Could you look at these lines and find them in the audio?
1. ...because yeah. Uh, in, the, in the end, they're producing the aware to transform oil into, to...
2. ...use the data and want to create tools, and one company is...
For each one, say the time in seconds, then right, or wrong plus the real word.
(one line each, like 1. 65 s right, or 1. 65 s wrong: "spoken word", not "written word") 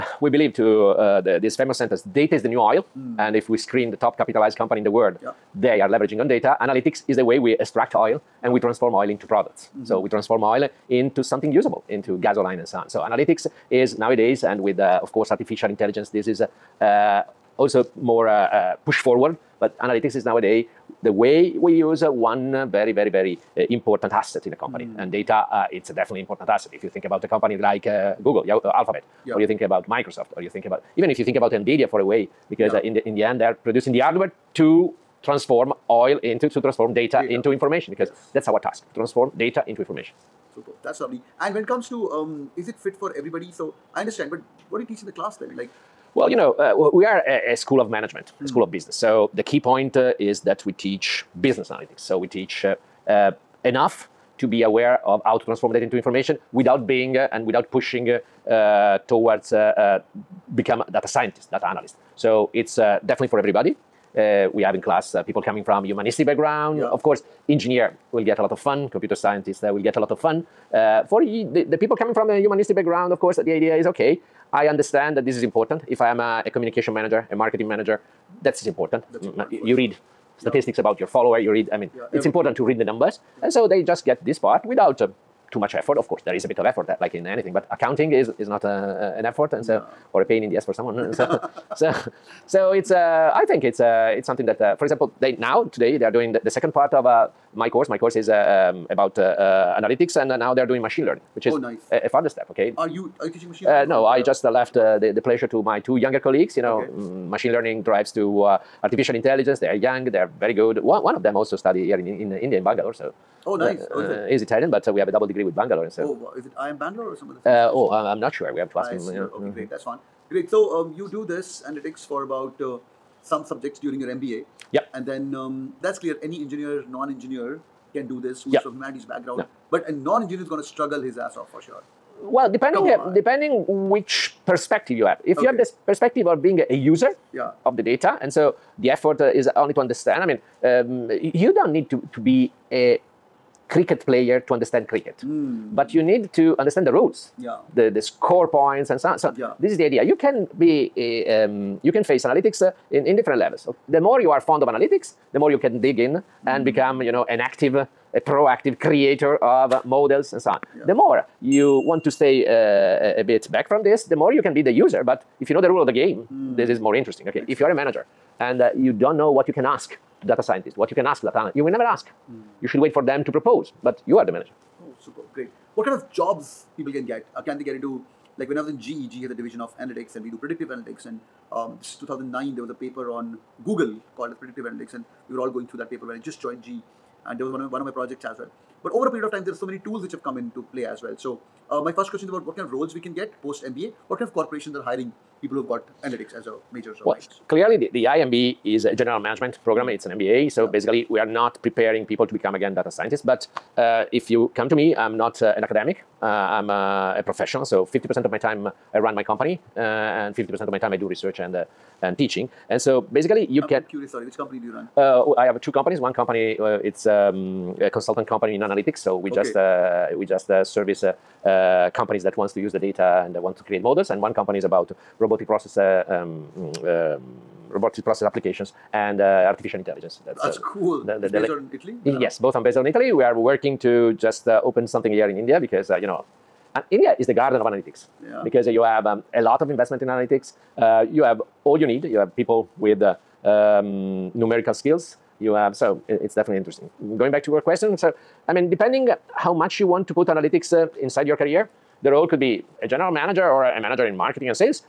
1. 32 s wrong: "hardware", not "aware"
2. 222 s wrong: "models", not "tools".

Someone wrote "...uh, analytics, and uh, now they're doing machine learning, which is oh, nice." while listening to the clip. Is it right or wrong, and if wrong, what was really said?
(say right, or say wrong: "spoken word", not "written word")
right.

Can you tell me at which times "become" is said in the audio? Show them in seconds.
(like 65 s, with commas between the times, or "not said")
60 s, 156 s, 202 s.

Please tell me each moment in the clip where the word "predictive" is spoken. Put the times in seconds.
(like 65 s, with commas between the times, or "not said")
180 s, 184 s.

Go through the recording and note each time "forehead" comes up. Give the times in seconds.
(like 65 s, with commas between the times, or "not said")
not said.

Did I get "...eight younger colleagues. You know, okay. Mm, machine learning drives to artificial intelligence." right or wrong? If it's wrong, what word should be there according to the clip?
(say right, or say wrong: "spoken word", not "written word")
wrong: "two", not "eight".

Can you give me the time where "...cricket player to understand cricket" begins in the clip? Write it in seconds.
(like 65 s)
143 s.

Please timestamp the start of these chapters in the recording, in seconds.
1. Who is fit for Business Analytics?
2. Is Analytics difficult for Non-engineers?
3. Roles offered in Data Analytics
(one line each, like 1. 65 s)
1. 41 s
2. 131 s
3. 195 s.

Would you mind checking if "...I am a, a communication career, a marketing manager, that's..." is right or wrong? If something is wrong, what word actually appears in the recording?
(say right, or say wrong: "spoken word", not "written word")
wrong: "manager", not "career".